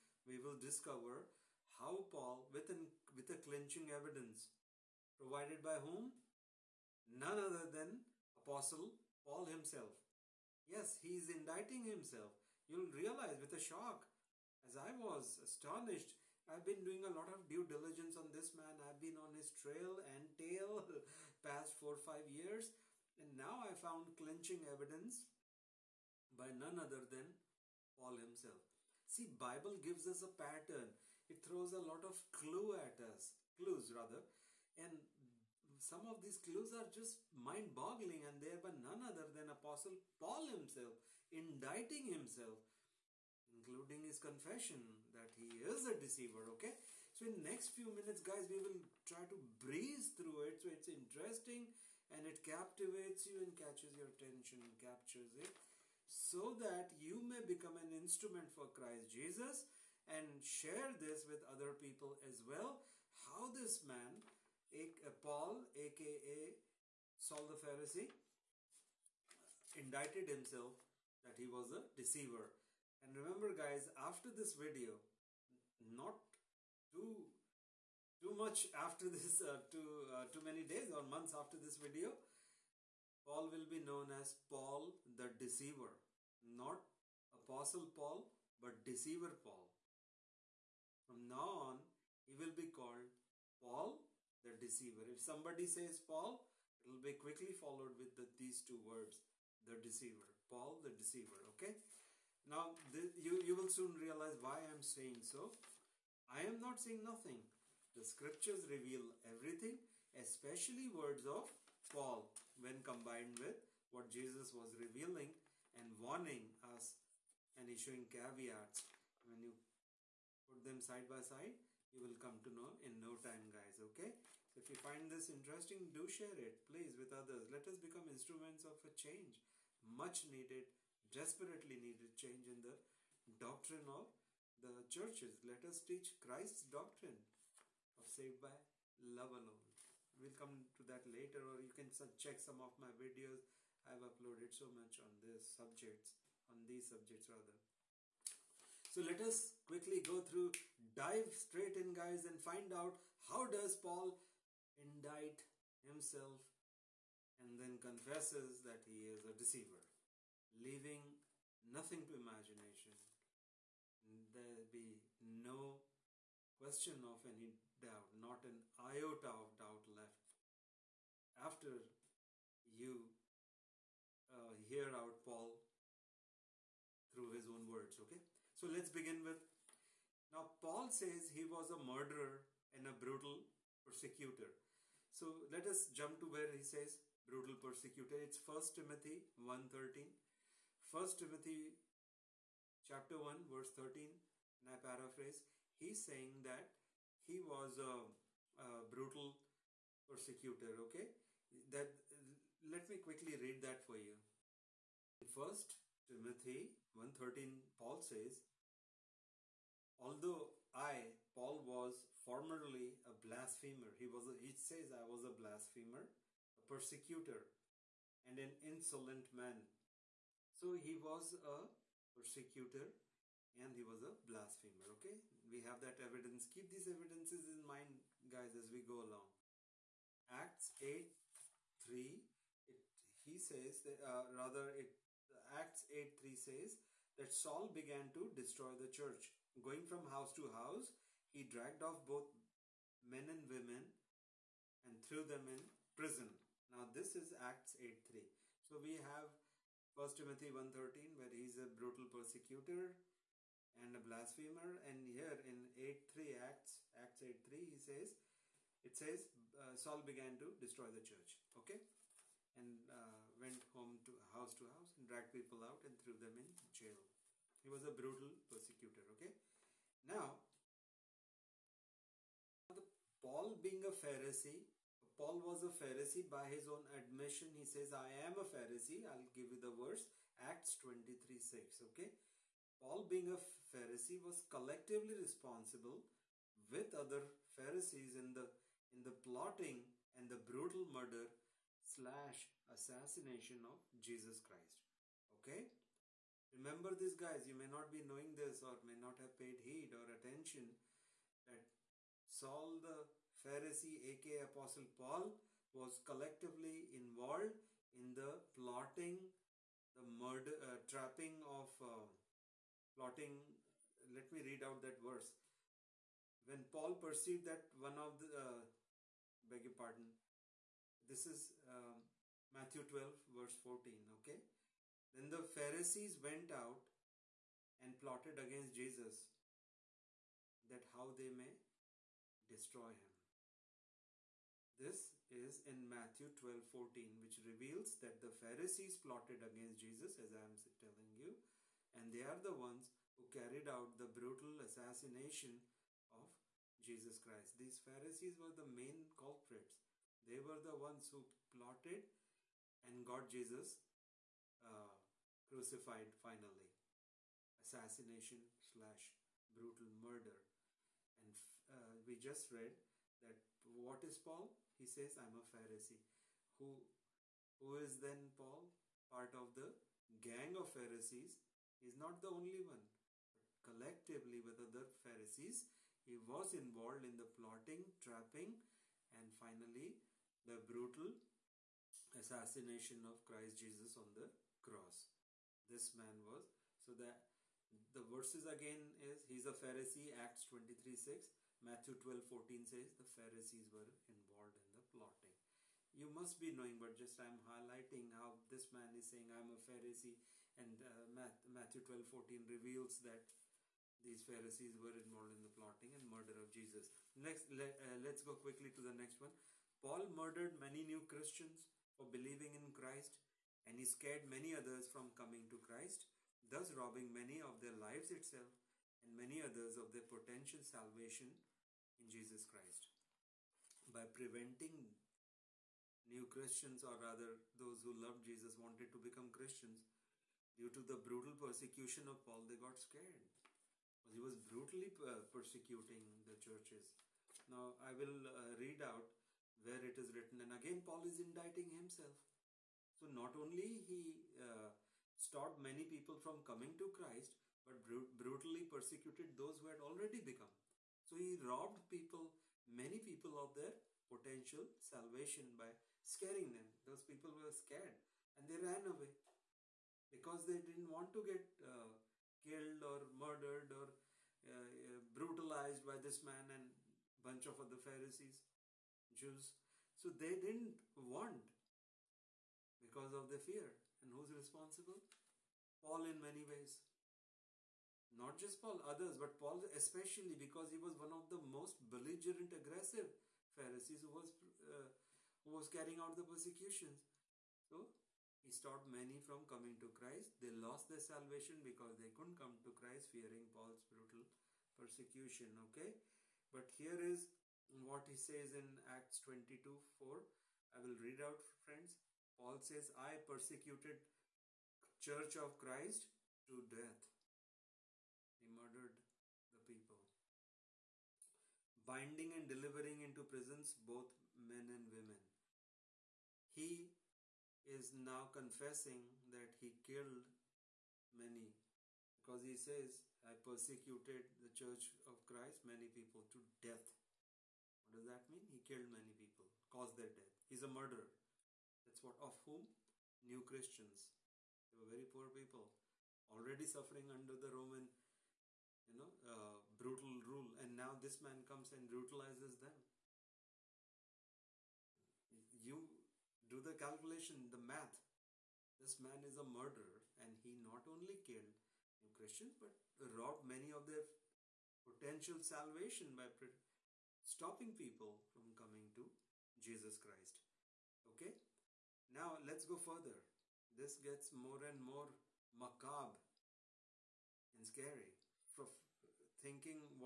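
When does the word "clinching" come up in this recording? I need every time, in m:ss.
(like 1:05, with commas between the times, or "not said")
0:03, 0:24.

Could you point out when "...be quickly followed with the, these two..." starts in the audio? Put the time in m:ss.
1:37.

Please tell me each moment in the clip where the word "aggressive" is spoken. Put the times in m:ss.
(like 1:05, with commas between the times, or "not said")
8:02.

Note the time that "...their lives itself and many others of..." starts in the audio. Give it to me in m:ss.
6:57.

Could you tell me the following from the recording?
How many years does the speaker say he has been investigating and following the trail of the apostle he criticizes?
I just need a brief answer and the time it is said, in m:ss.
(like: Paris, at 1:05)
four or five years, at 0:21.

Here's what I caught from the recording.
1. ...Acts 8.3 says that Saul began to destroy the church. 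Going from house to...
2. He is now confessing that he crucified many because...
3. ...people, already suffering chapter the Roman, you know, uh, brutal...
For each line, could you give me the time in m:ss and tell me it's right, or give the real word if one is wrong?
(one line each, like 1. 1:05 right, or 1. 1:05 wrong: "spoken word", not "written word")
1. 3:55 right
2. 8:36 wrong: "killed", not "crucified"
3. 8:55 wrong: "under", not "chapter".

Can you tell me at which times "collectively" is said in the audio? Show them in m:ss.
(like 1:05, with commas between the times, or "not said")
4:44, 5:05, 6:13.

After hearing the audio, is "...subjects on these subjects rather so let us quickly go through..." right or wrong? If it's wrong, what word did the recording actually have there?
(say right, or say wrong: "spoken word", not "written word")
right.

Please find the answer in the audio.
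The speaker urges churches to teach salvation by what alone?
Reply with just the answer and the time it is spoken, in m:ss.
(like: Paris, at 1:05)
love alone, at 2:18.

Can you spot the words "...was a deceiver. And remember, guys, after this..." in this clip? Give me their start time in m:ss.
1:11.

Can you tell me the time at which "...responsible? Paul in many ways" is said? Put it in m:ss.
7:54.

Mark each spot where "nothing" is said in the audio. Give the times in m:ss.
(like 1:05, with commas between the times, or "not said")
1:47, 2:41.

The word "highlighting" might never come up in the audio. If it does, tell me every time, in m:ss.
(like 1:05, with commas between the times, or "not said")
6:37.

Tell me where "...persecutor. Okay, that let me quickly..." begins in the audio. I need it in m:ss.
3:20.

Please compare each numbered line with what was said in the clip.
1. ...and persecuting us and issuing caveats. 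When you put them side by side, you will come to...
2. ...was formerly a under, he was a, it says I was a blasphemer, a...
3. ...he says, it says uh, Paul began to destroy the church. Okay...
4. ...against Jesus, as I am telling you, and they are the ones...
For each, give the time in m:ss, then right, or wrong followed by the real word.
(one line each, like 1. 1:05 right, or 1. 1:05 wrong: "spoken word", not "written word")
1. 1:55 wrong: "warning", not "persecuting"
2. 3:31 wrong: "blasphemer", not "under"
3. 4:17 wrong: "Saul", not "Paul"
4. 5:39 right.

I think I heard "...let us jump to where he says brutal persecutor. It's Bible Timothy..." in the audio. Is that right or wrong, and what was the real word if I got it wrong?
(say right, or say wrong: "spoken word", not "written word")
wrong: "First", not "Bible".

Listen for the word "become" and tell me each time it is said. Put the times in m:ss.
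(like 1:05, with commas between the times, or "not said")
0:57, 2:07, 7:08, 7:30.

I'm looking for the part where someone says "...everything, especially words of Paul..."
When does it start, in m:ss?
1:49.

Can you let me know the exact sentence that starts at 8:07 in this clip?
So he stopped many from coming to Christ.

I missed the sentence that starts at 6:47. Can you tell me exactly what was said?
Next, uh, let's go quickly to the next one.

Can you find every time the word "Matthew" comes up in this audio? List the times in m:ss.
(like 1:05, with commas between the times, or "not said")
5:22, 5:35, 6:31, 6:41.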